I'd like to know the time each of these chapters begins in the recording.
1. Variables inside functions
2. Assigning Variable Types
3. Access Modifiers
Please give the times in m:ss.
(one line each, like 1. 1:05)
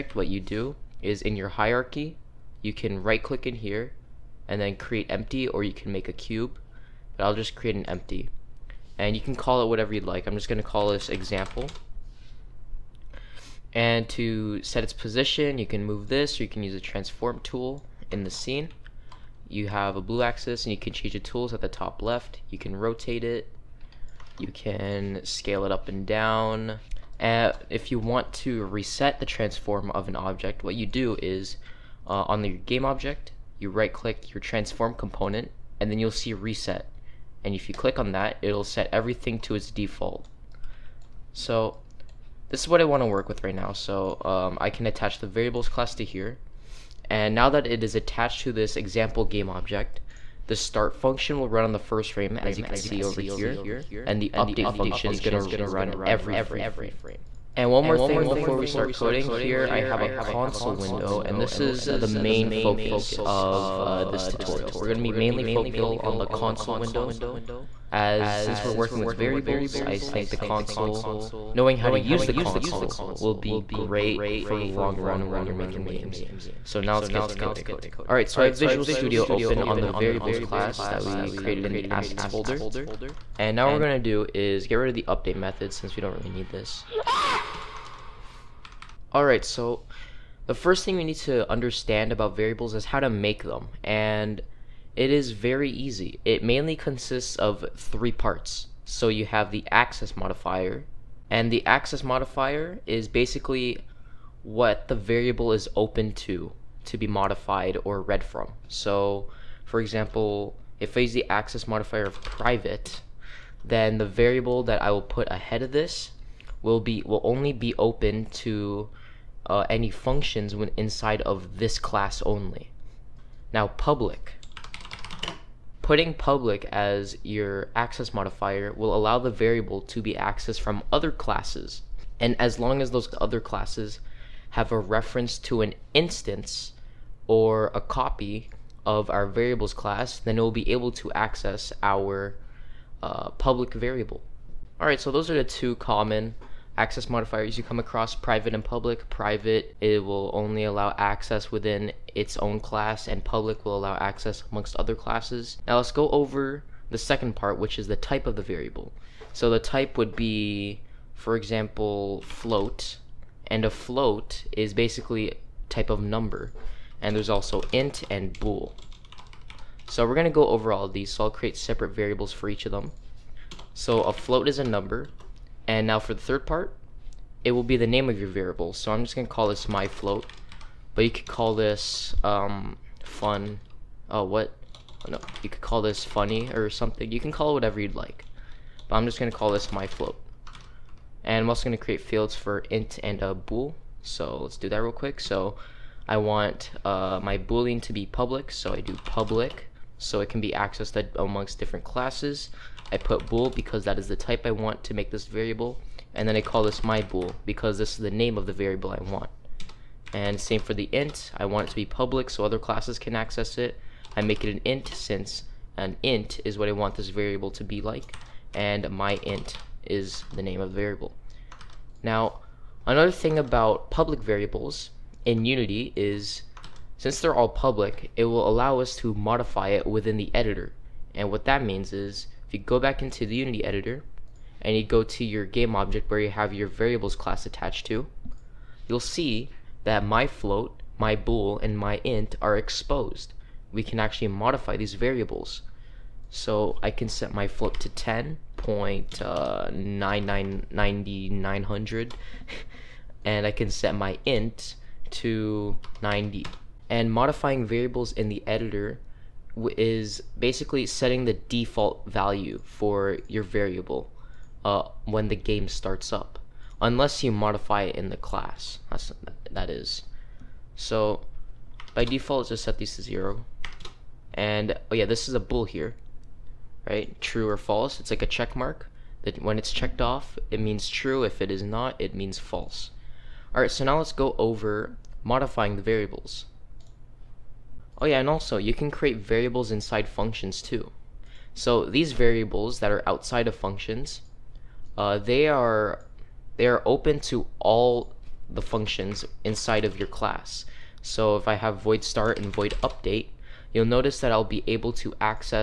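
1. 4:46
2. 2:35
3. 1:16.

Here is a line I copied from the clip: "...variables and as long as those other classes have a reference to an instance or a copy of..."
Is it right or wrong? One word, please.
wrong.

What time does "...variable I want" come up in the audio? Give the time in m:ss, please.
3:28.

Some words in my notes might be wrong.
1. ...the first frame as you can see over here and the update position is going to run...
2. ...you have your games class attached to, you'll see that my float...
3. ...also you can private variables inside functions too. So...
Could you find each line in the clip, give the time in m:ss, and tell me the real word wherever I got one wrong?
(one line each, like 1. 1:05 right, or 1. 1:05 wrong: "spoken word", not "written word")
1. 0:51 wrong: "function", not "position"
2. 3:56 wrong: "variables", not "games"
3. 4:48 wrong: "create", not "private".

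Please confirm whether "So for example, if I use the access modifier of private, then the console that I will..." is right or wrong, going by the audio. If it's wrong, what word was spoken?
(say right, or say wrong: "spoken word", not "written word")
wrong: "variable", not "console".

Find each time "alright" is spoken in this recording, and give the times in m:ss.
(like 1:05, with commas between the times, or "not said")
1:18, 1:29, 2:24, 4:43.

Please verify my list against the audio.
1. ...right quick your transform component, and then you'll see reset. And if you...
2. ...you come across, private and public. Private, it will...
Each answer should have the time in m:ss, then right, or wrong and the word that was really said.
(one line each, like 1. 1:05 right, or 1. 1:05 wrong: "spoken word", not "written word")
1. 0:33 wrong: "click", not "quick"
2. 2:27 right.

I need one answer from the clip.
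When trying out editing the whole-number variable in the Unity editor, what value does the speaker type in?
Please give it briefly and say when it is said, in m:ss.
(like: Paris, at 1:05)
90, at 4:15.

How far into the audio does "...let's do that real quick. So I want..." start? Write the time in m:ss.
3:14.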